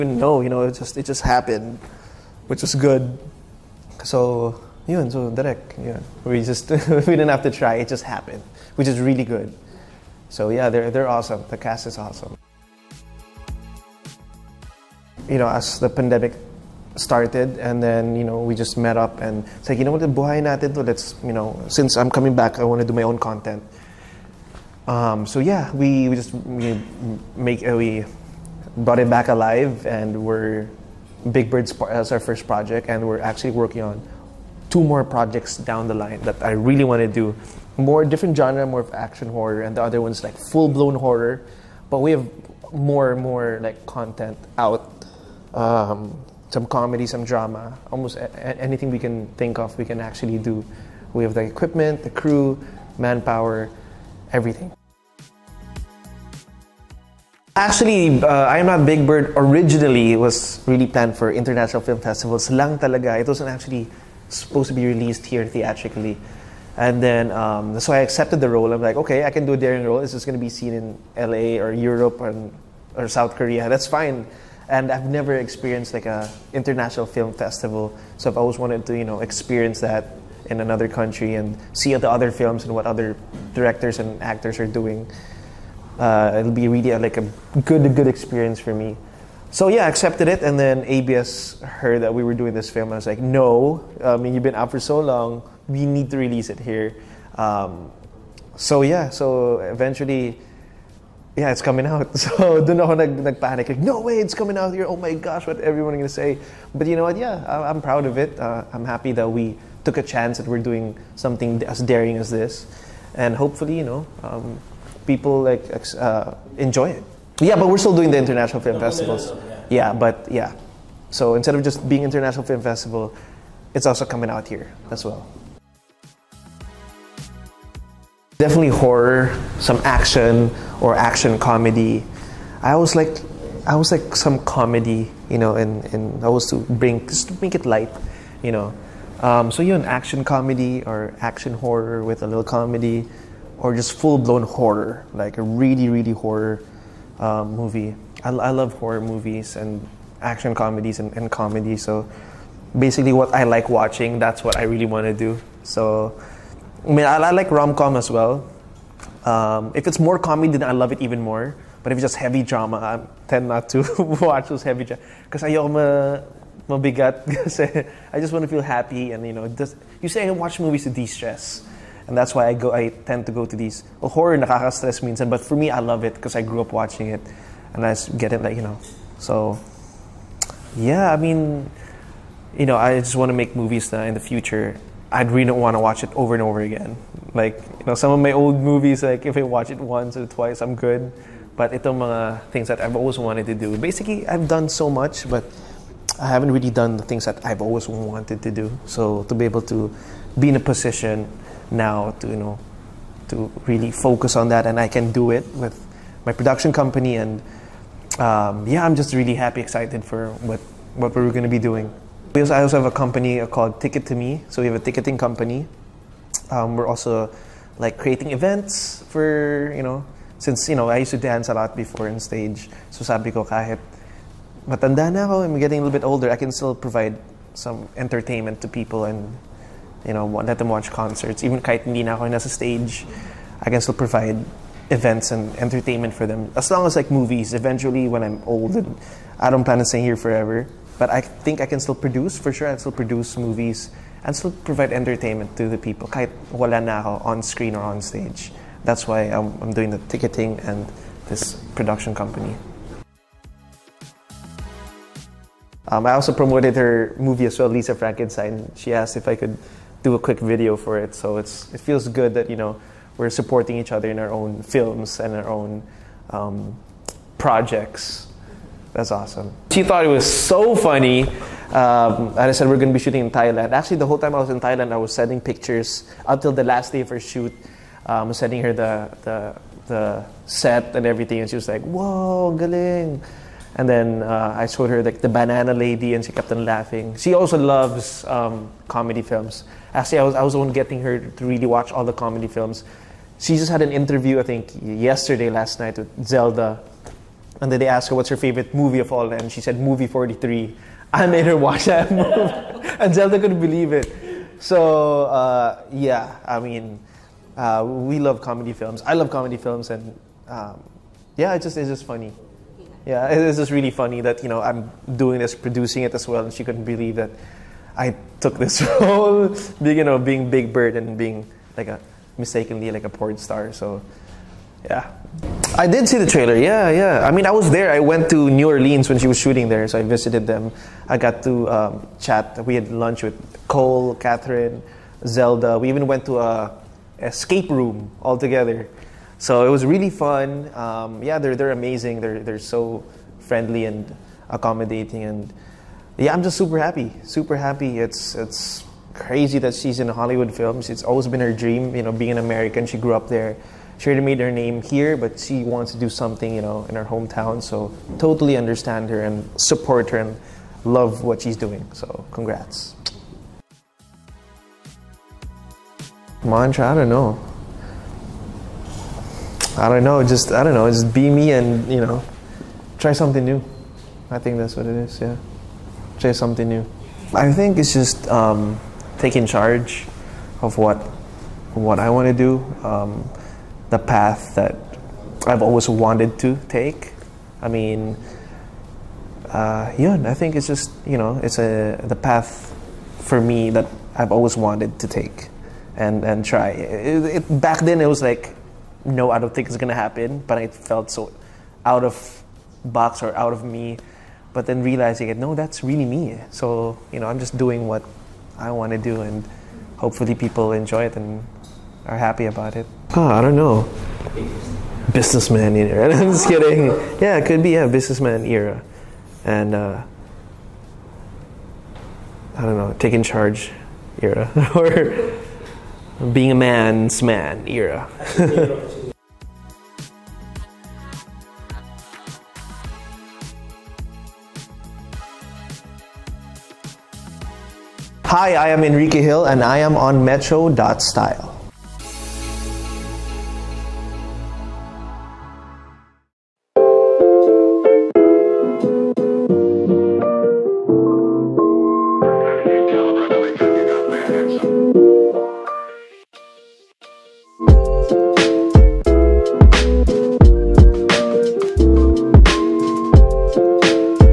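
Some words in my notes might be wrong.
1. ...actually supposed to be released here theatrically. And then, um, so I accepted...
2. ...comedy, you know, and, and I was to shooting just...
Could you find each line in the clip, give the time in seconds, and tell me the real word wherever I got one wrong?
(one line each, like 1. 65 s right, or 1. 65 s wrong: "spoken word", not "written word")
1. 63 s right
2. 134 s wrong: "bring", not "shooting".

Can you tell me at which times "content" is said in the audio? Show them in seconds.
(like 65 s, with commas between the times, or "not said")
23 s, 43 s.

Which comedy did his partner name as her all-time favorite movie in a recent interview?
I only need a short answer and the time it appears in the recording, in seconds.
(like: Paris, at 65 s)
Movie 43, at 299 s.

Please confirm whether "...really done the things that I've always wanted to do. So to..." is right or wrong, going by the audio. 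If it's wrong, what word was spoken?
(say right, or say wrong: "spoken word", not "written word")
right.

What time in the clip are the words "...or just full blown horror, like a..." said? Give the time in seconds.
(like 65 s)
143 s.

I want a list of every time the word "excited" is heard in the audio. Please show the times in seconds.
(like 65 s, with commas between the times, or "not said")
209 s.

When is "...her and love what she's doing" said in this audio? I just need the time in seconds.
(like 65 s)
360 s.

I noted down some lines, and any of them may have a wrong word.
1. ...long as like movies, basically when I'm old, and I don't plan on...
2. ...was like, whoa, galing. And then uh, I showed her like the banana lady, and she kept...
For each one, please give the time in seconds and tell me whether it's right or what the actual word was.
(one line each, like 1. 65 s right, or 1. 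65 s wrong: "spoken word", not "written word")
1. 236 s wrong: "eventually", not "basically"
2. 281 s right.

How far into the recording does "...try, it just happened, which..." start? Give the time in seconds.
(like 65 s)
7 s.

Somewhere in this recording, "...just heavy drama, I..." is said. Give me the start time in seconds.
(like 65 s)
162 s.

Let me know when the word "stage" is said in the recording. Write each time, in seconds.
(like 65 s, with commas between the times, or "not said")
222 s, 232 s, 248 s.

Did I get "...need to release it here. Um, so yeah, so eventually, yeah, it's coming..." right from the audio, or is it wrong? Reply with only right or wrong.
right.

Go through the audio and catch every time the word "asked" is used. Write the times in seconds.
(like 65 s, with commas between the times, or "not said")
258 s, 297 s.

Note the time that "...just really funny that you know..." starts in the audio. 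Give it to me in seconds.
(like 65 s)
313 s.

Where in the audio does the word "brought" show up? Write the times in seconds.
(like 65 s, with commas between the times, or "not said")
28 s.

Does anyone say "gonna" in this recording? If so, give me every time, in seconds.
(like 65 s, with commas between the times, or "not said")
106 s, 399 s.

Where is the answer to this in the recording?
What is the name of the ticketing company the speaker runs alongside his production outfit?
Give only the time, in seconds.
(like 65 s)
213 s.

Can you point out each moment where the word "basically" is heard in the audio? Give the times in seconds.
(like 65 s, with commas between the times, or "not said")
152 s, 193 s.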